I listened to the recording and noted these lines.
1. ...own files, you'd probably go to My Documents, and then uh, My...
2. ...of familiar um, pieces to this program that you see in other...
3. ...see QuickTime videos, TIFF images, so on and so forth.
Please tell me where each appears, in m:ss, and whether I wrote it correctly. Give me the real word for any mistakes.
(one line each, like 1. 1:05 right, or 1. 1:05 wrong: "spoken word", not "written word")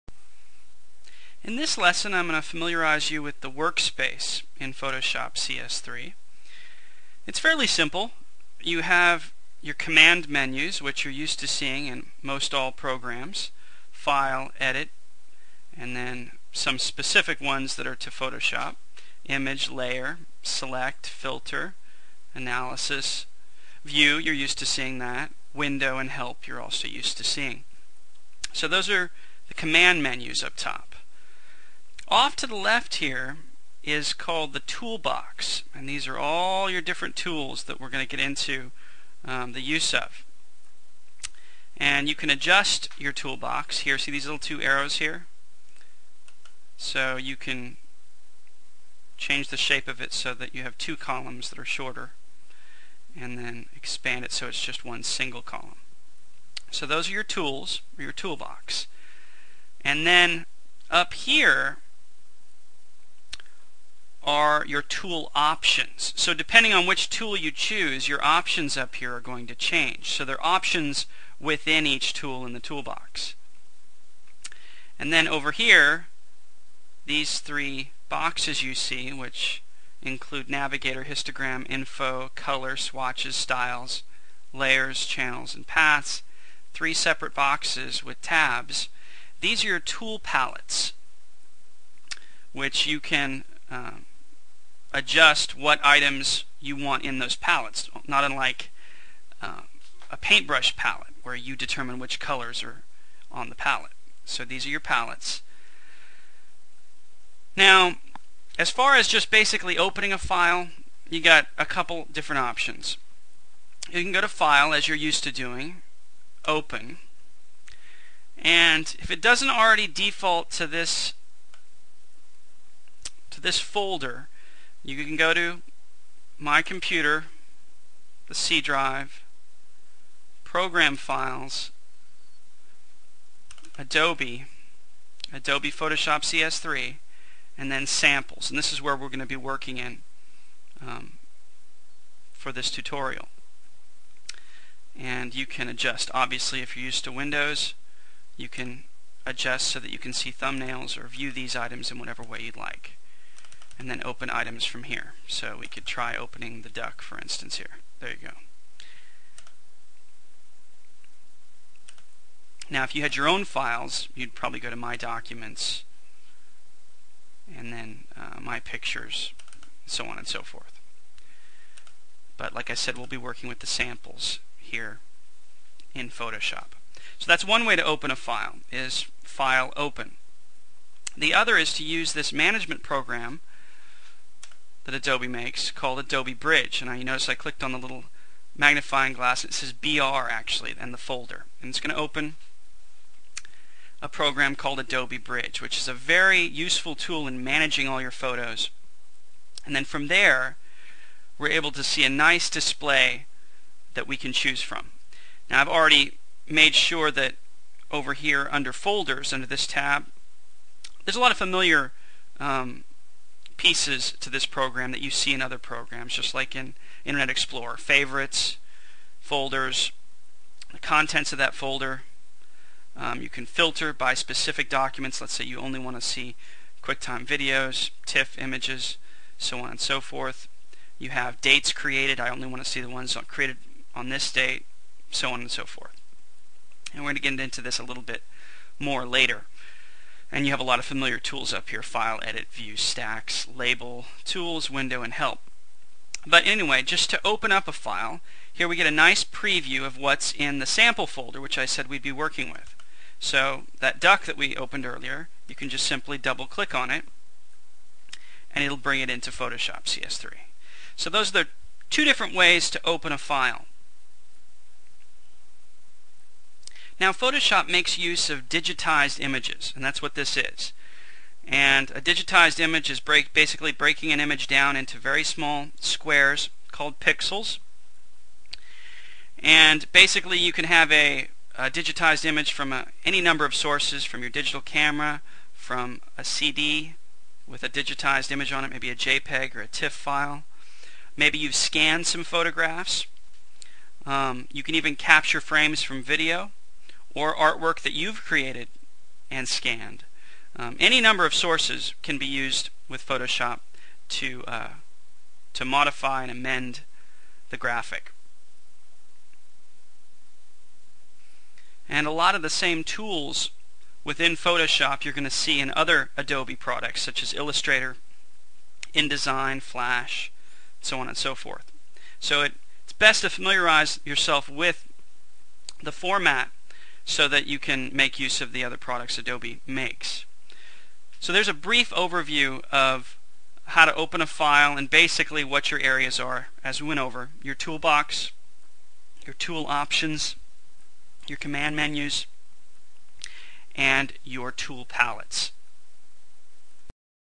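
1. 2:43 right
2. 3:31 right
3. 3:46 right.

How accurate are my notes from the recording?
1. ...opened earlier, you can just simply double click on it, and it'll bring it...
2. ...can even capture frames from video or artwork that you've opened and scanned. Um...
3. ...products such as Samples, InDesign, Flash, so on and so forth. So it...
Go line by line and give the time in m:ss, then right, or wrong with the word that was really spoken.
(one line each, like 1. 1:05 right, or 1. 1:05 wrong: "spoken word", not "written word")
1. 4:14 right
2. 4:54 wrong: "created", not "opened"
3. 5:16 wrong: "Illustrator", not "Samples".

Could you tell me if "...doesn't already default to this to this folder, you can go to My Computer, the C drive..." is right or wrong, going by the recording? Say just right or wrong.
right.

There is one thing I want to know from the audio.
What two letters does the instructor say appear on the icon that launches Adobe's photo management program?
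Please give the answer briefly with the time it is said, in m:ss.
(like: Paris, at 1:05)
BR, at 3:09.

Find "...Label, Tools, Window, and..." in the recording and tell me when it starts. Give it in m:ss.
4:03.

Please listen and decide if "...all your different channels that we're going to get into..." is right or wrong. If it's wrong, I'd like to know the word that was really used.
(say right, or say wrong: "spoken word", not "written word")
wrong: "tools", not "channels".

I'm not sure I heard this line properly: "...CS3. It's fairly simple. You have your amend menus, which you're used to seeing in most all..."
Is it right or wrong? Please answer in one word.
wrong.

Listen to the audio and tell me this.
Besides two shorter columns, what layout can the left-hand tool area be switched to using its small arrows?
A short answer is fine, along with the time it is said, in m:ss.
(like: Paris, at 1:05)
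one single column, at 0:54.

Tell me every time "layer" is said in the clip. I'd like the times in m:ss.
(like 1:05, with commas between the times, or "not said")
0:19, 1:24.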